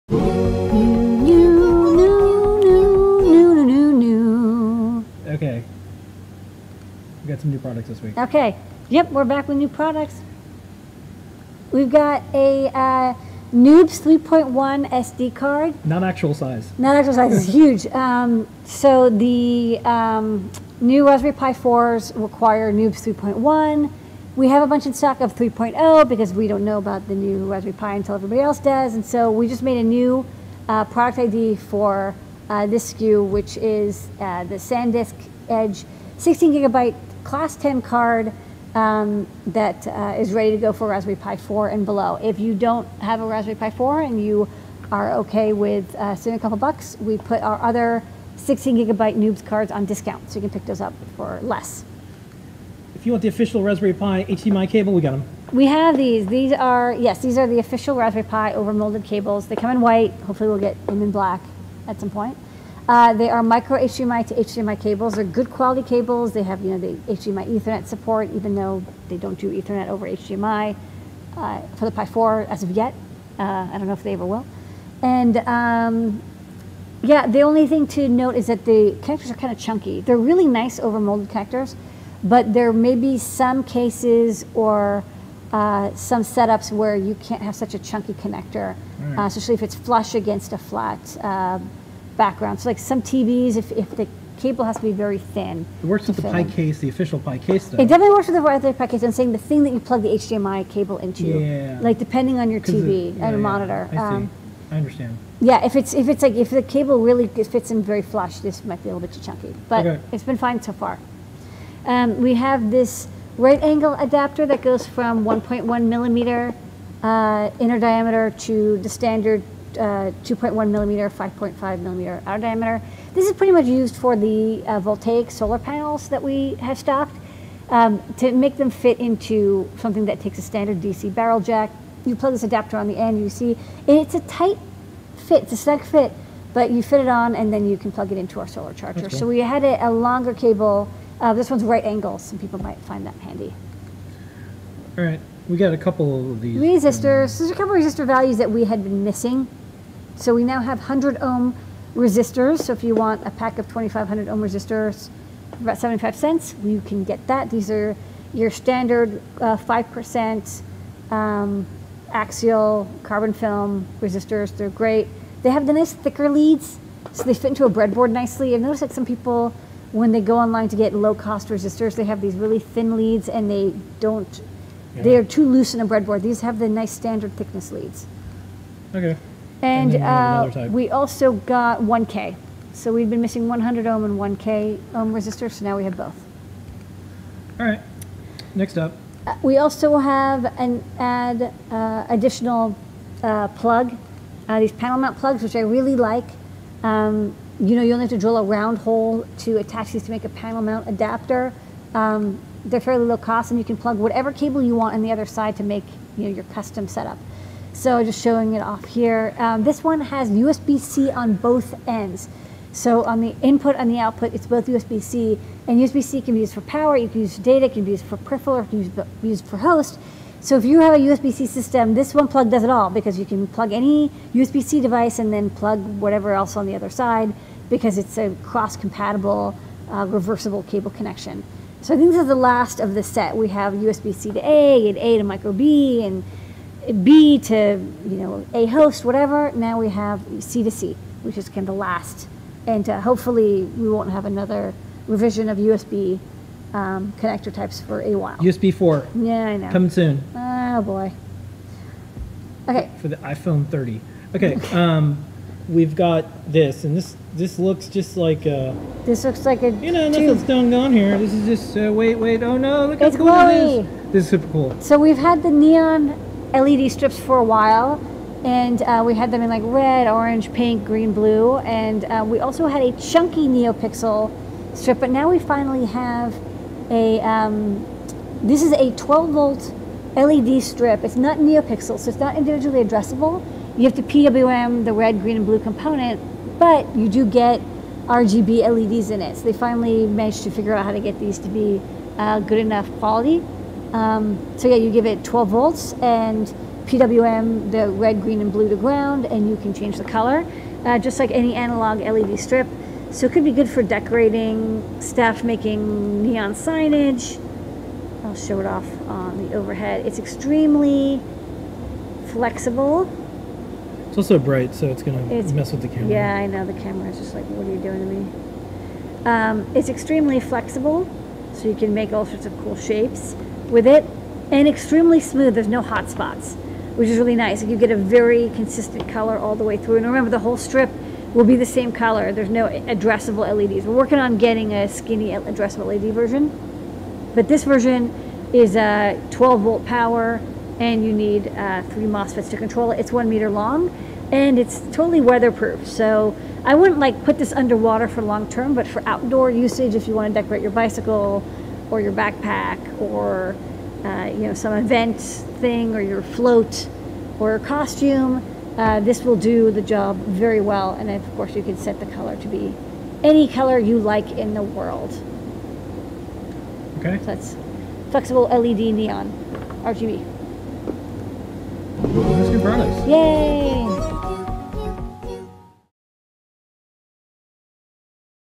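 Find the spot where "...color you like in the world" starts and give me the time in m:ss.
6:03.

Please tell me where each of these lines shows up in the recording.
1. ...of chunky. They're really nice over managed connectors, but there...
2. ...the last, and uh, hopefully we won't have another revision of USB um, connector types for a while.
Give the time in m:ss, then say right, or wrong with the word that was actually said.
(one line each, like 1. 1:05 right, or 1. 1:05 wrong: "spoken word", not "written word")
1. 1:19 wrong: "molded", not "managed"
2. 4:01 right.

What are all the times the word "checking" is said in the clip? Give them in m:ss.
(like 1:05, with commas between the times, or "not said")
not said.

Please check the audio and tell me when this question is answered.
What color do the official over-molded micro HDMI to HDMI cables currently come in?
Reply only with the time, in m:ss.
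0:59.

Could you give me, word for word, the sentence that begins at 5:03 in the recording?
So it could be good for decorating, staff making neon signage.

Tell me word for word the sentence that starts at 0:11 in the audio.
We've got a uh, Noobs 3.1 SD card.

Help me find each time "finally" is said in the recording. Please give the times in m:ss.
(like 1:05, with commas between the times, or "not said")
4:35, 4:49.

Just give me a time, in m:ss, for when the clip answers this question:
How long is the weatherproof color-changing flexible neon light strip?
5:43.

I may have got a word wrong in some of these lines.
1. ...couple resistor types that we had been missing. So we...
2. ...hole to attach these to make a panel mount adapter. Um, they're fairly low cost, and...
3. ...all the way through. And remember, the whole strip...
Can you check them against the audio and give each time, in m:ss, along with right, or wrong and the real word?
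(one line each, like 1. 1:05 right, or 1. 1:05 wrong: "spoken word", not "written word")
1. 2:27 wrong: "values", not "types"
2. 3:18 right
3. 5:29 right.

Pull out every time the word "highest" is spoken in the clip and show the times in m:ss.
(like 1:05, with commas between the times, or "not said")
not said.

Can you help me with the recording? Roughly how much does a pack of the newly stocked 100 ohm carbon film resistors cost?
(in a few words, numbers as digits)
75 cents.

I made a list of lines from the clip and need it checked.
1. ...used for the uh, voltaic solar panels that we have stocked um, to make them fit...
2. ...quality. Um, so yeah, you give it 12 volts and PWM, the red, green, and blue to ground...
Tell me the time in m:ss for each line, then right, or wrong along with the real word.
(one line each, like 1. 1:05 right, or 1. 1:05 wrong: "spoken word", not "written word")
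1. 2:03 right
2. 4:52 right.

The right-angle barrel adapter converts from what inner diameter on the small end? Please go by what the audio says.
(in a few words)
1.1 millimeter.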